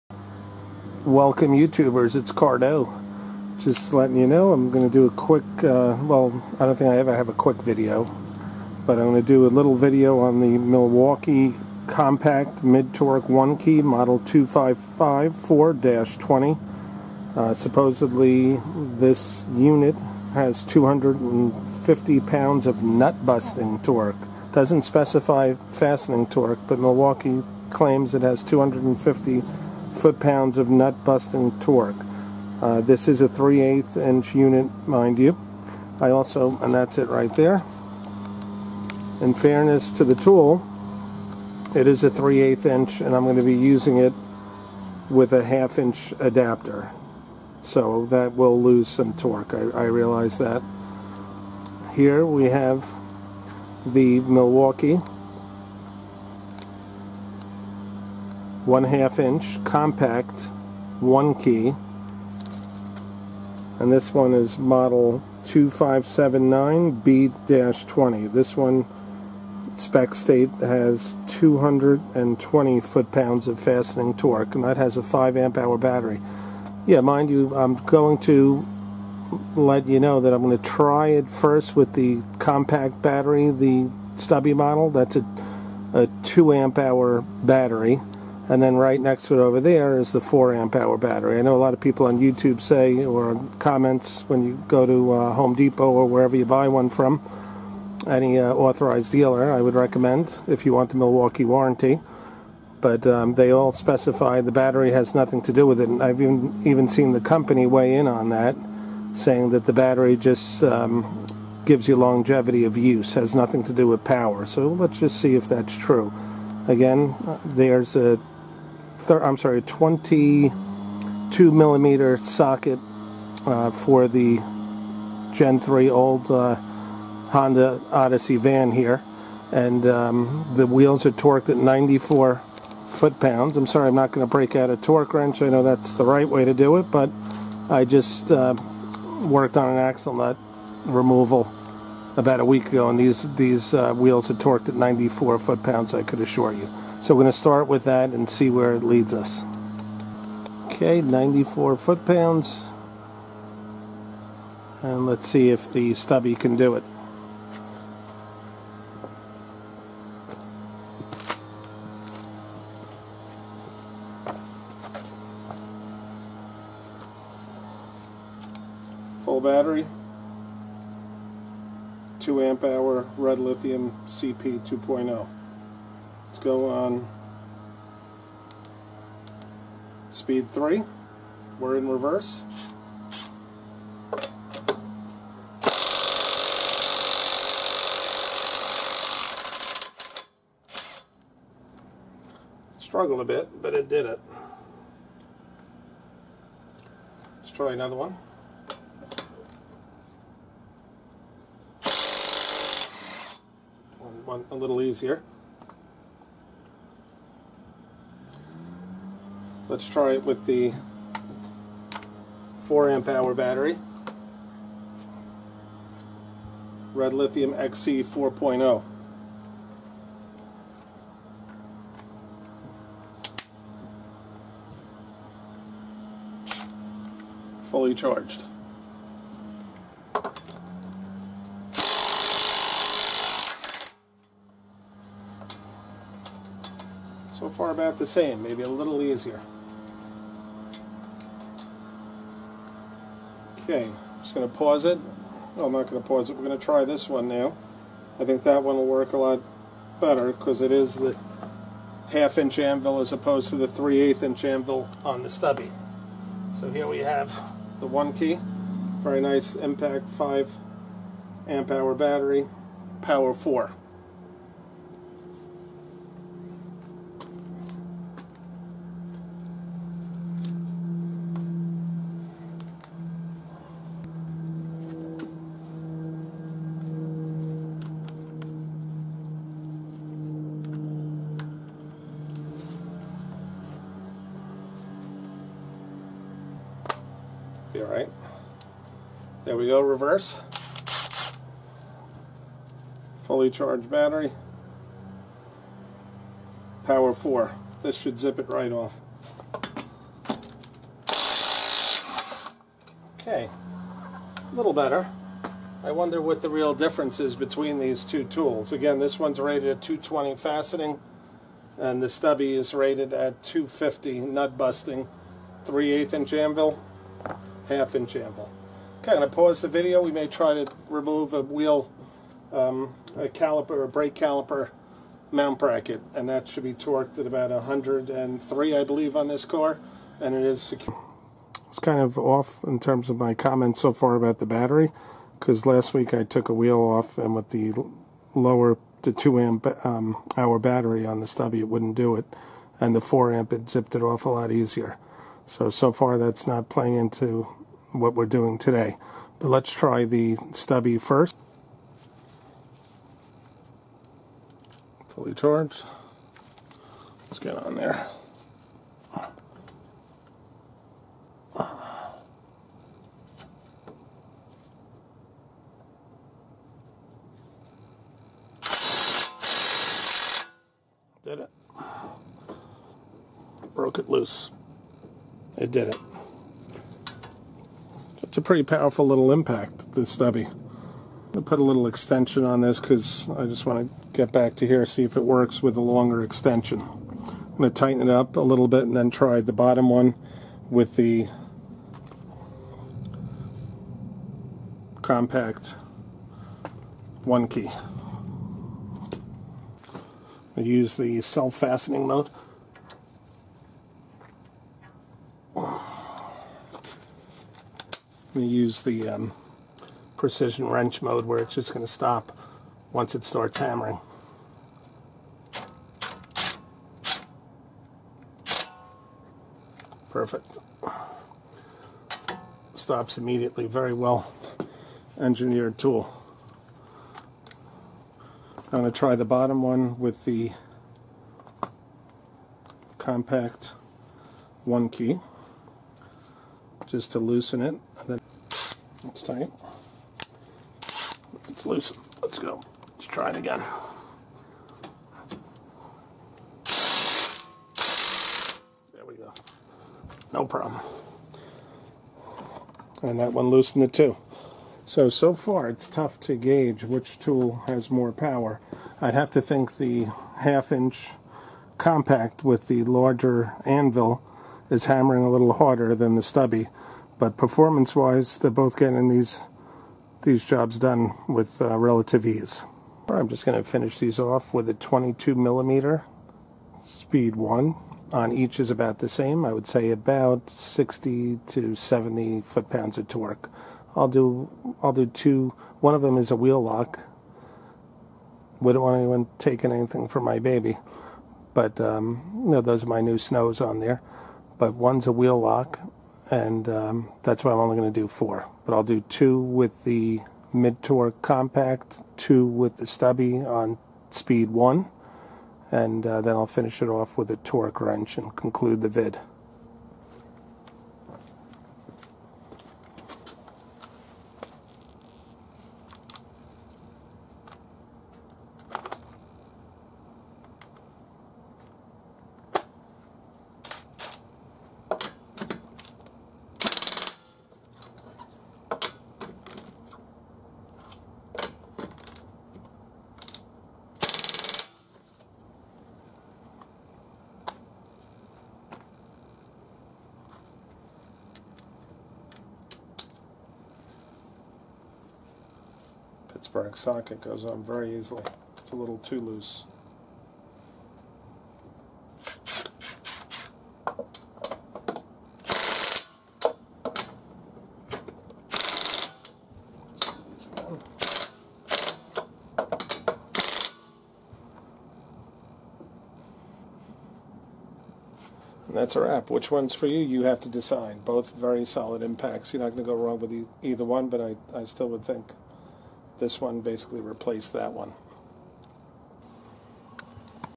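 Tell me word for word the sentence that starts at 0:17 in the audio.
Uh, supposedly, this unit has 250 pounds of nut-busting torque.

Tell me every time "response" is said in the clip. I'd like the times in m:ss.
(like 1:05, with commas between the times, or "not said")
not said.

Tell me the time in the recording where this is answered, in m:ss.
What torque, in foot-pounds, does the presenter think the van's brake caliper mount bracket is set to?
5:27.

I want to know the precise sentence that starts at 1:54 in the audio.
So let's just see if that's true.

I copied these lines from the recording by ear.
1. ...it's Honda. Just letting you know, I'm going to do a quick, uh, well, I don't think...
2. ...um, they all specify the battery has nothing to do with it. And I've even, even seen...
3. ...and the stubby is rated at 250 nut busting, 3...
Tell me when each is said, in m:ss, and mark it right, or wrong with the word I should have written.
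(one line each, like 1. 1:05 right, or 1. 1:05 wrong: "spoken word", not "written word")
1. 0:02 wrong: "Cardo", not "Honda"
2. 1:43 right
3. 5:11 right.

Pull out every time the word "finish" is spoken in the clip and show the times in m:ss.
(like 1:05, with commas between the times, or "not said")
7:53, 8:26.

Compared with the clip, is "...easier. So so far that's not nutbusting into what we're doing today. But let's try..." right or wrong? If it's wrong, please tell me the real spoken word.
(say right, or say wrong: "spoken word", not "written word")
wrong: "playing", not "nutbusting".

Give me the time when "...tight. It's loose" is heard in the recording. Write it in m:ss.
7:19.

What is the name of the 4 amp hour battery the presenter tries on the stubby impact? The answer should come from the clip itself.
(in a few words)
Red Lithium XC 4.0.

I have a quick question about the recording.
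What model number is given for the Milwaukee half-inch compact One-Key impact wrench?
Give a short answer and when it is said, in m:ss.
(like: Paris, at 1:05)
2579B-20, at 1:05.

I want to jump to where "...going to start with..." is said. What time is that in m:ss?
2:27.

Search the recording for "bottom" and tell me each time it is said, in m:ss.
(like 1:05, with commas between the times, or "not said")
6:29, 7:09.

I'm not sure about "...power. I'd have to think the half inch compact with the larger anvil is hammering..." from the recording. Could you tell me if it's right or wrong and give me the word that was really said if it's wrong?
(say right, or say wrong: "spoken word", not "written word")
right.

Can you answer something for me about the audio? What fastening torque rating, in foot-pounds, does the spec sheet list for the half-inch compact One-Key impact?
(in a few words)
220 foot-pounds.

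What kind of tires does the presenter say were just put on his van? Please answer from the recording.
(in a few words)
snows.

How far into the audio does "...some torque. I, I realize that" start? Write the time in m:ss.
0:48.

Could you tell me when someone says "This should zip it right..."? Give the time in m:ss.
4:57.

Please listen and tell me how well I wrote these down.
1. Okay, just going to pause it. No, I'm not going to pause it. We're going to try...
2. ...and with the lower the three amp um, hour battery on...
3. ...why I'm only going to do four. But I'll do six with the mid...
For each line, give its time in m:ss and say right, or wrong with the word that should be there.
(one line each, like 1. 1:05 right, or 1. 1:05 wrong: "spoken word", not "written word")
1. 4:03 right
2. 5:37 wrong: "two", not "three"
3. 8:17 wrong: "two", not "six".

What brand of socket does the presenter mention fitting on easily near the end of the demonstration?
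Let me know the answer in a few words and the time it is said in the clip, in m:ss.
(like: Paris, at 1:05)
Pittsburgh, at 9:06.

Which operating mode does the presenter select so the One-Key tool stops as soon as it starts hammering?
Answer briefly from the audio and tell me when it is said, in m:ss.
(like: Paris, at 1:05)
precision wrench mode, at 6:50.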